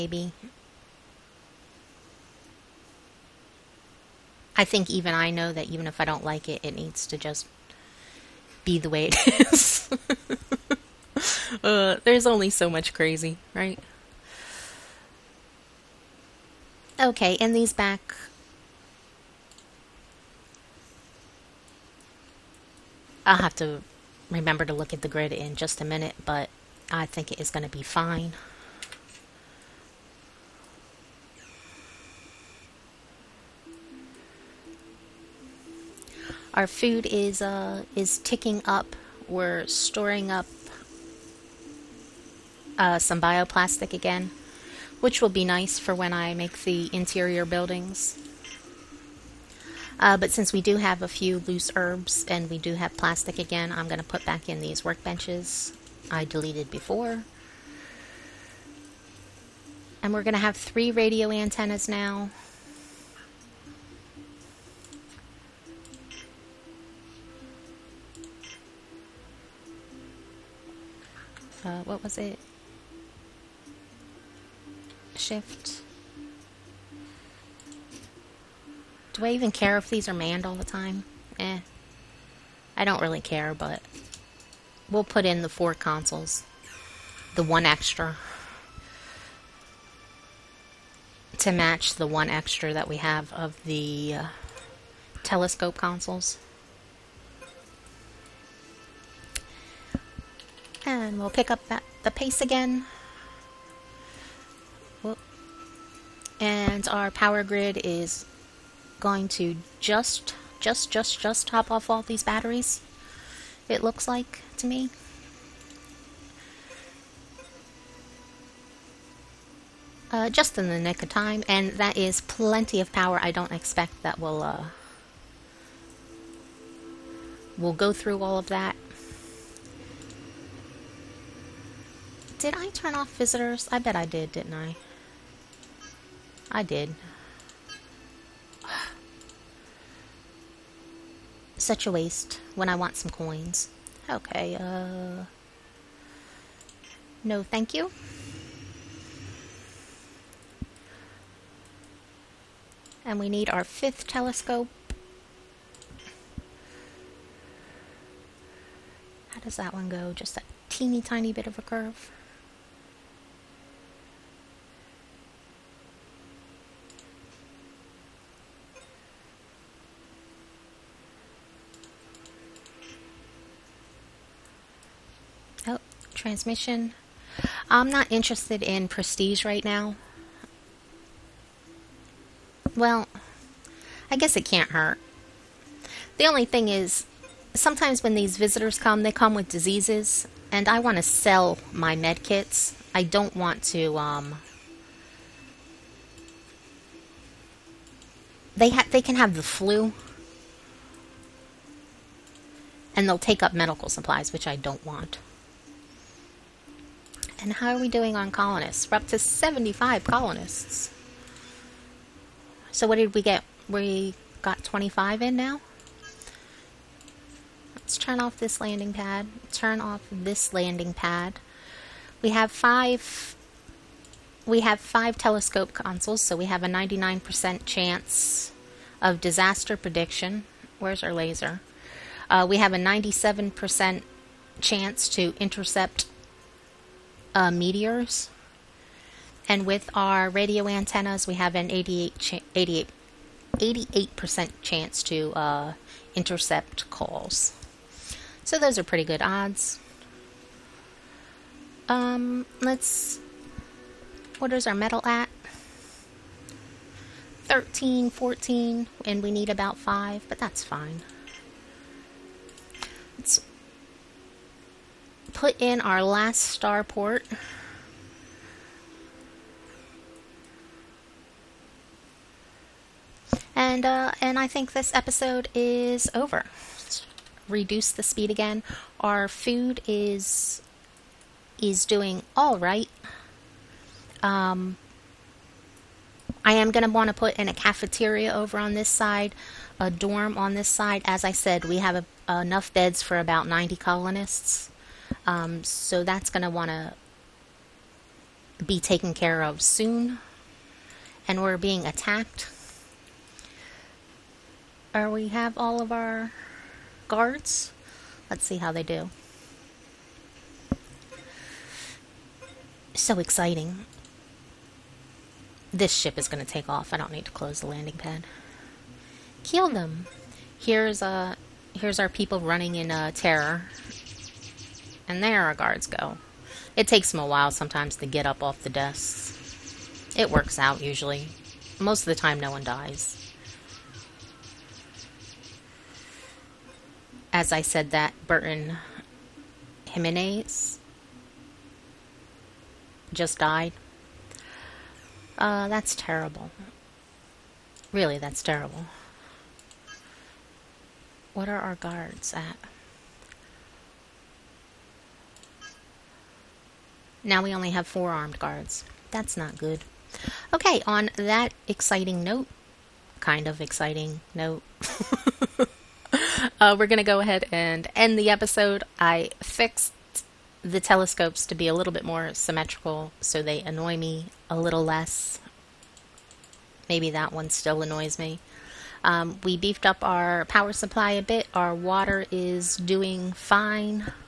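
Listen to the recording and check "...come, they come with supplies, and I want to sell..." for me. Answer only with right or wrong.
wrong.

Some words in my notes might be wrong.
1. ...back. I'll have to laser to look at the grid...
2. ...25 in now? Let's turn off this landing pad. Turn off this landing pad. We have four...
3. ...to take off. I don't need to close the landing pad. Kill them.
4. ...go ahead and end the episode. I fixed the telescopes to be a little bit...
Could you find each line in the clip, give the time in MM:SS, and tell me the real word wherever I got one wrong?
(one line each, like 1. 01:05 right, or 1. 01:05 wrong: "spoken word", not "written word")
1. 00:17 wrong: "remember", not "laser"
2. 03:34 wrong: "five", not "four"
3. 05:16 right
4. 06:07 right.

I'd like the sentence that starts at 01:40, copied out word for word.
And we'll pick up that, the pace again.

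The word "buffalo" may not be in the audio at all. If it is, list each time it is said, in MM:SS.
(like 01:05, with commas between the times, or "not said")
not said.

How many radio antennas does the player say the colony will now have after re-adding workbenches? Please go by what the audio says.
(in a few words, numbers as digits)
3.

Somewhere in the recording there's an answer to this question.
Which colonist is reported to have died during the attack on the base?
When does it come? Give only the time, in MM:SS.
05:38.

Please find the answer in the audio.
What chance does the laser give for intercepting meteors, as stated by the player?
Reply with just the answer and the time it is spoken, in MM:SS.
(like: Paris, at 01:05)
97%, at 03:52.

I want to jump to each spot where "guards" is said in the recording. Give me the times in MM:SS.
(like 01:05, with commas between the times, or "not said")
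05:07, 05:25, 05:51, 05:58.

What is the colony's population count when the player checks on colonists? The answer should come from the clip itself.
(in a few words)
75.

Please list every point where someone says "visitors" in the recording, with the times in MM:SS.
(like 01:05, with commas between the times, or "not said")
02:13, 03:08.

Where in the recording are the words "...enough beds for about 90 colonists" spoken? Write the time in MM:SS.
04:52.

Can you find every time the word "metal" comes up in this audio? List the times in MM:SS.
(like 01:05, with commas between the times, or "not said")
04:14.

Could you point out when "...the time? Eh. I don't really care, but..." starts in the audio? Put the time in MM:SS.
01:20.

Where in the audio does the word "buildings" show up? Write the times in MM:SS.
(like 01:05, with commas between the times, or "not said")
00:47.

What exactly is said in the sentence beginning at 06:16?
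Maybe that one still annoys me.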